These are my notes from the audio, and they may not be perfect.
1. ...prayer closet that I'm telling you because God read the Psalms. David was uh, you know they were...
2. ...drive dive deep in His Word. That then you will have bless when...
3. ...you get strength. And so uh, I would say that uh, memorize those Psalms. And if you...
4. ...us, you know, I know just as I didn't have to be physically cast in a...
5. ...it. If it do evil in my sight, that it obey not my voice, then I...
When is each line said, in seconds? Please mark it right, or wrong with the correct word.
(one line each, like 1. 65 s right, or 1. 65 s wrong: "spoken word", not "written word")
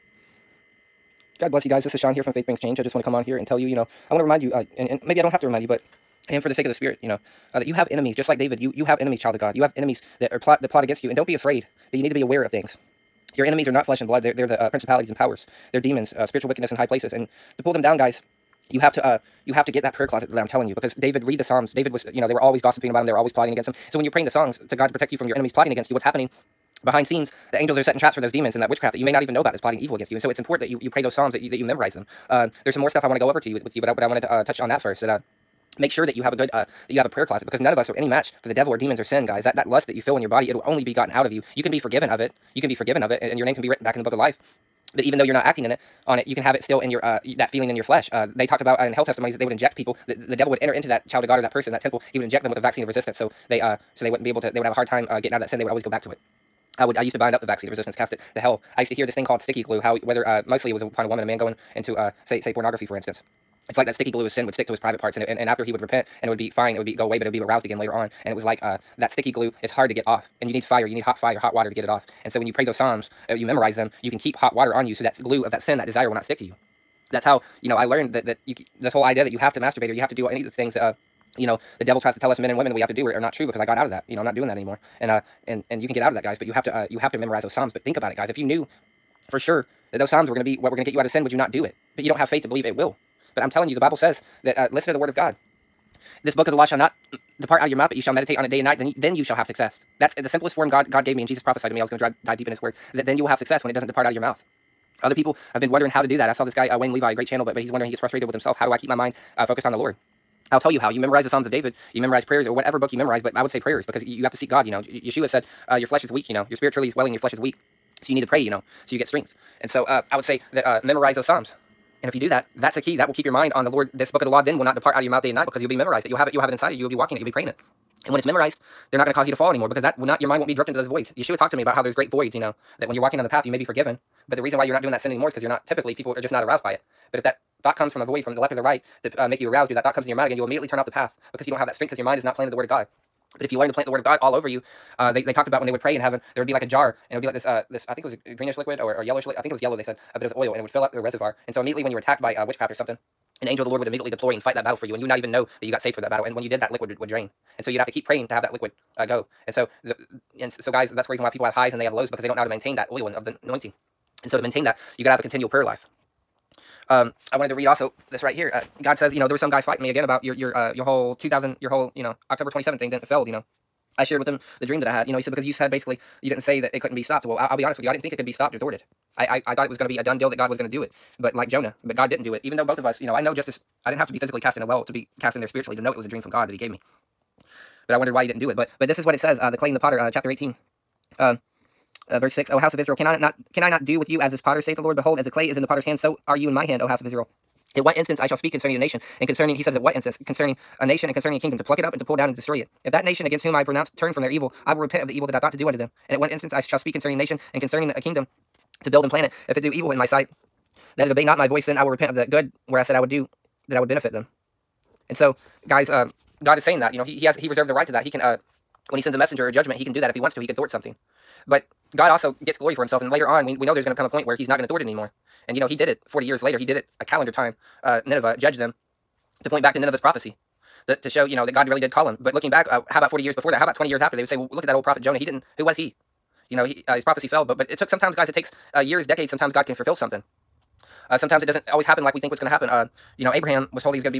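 1. 19 s wrong: "David", not "God"
2. 101 s wrong: "success", not "bless"
3. 118 s right
4. 182 s right
5. 209 s right.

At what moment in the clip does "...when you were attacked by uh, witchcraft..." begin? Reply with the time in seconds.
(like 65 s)
151 s.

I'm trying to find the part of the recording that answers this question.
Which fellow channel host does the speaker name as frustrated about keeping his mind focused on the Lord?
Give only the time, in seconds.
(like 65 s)
106 s.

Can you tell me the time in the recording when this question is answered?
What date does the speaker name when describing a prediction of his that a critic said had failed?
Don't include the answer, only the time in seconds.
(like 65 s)
172 s.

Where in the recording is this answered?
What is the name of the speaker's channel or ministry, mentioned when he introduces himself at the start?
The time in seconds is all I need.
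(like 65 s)
2 s.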